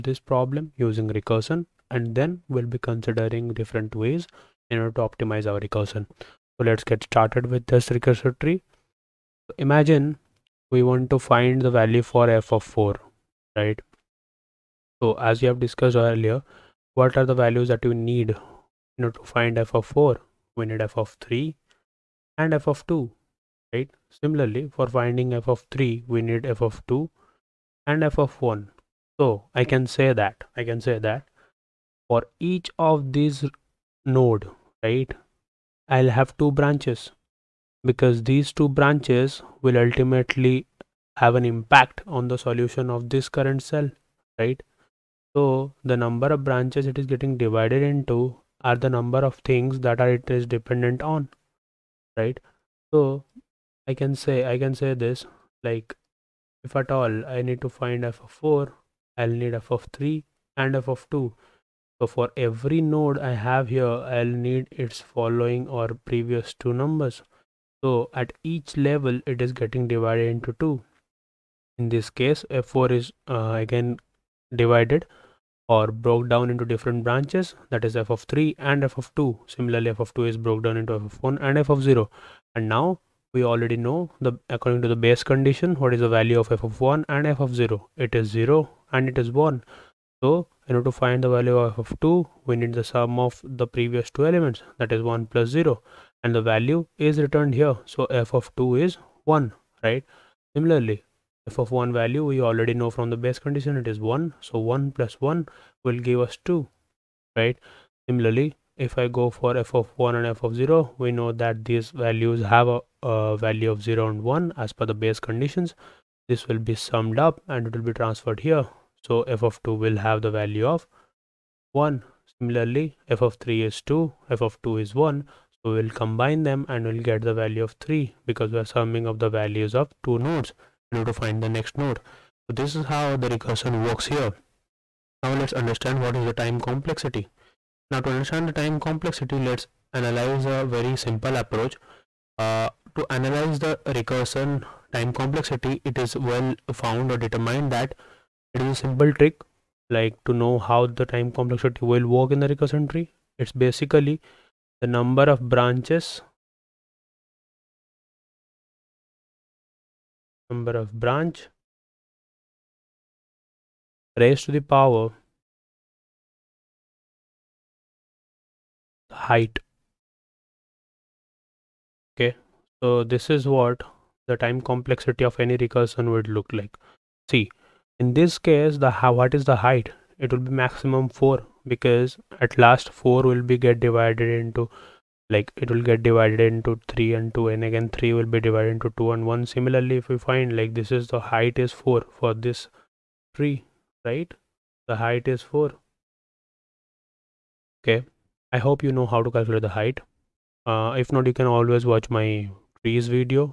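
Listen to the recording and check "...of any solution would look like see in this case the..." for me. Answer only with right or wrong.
wrong.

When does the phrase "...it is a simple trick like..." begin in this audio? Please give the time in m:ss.
2:28.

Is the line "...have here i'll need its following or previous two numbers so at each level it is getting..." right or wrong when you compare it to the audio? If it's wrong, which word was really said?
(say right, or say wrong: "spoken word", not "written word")
right.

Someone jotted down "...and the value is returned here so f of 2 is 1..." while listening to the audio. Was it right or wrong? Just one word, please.
right.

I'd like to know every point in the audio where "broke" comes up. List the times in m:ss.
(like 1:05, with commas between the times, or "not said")
1:15, 1:20.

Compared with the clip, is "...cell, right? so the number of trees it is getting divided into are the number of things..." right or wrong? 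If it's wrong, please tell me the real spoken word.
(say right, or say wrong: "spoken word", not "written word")
wrong: "branches", not "trees".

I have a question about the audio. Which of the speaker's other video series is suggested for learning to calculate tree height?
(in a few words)
trees.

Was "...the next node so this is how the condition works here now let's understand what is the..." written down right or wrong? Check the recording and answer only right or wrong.
wrong.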